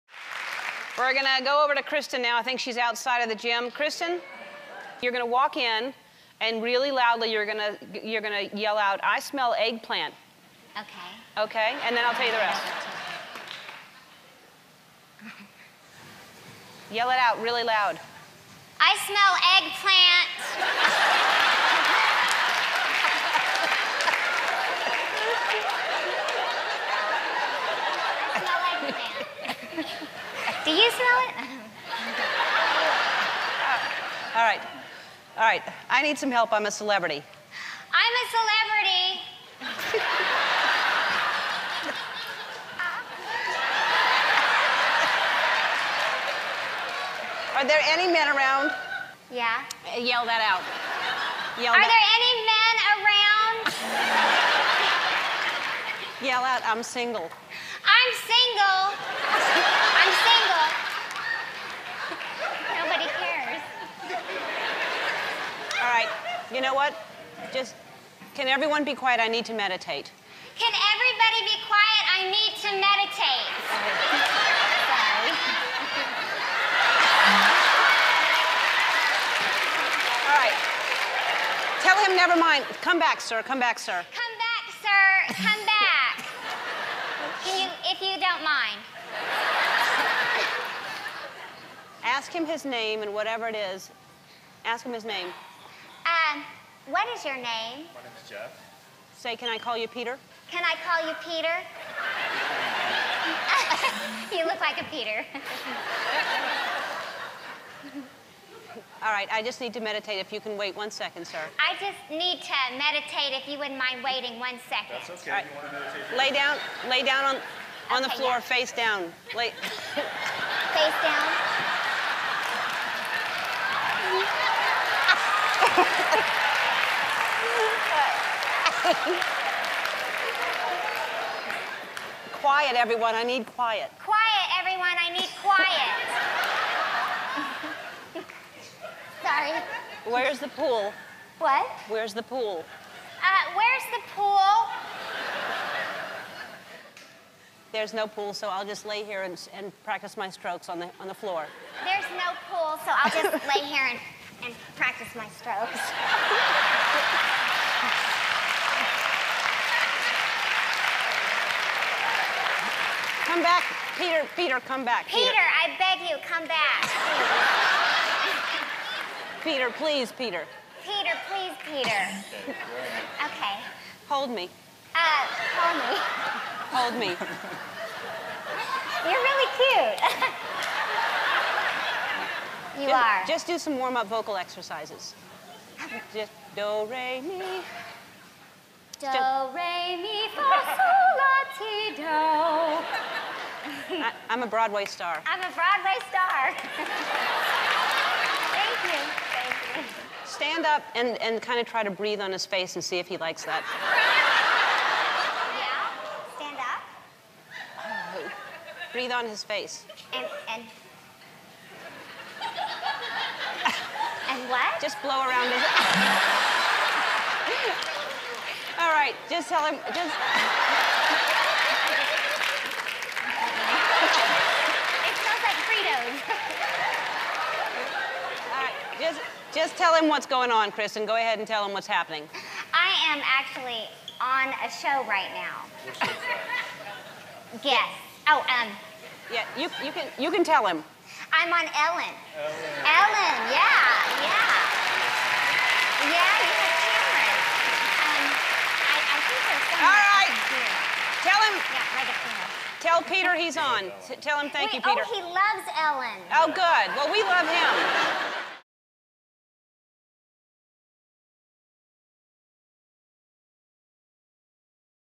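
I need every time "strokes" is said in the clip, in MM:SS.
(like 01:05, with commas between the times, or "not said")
02:30, 02:35.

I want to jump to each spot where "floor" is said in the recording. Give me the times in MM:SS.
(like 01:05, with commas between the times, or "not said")
01:58, 02:31.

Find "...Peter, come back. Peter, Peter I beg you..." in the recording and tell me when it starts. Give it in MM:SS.
02:44.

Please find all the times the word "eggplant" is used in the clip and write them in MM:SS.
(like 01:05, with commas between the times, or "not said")
00:09, 00:20.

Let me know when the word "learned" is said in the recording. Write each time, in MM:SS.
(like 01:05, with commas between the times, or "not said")
not said.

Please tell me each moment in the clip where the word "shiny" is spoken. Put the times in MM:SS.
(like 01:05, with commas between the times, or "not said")
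not said.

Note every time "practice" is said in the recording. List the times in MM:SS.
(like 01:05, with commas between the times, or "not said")
02:29, 02:34.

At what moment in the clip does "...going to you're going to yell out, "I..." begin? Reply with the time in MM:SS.
00:07.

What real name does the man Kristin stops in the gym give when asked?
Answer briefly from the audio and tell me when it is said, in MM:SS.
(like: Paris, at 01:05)
Jeff, at 01:37.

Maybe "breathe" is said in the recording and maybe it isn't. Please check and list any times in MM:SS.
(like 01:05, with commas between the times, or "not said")
03:21, 03:28.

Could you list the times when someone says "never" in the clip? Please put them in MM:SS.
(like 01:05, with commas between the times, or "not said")
01:22.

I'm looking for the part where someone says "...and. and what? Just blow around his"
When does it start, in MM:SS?
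03:30.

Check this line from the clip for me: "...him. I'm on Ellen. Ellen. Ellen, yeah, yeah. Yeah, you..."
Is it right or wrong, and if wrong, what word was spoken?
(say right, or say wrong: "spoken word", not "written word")
right.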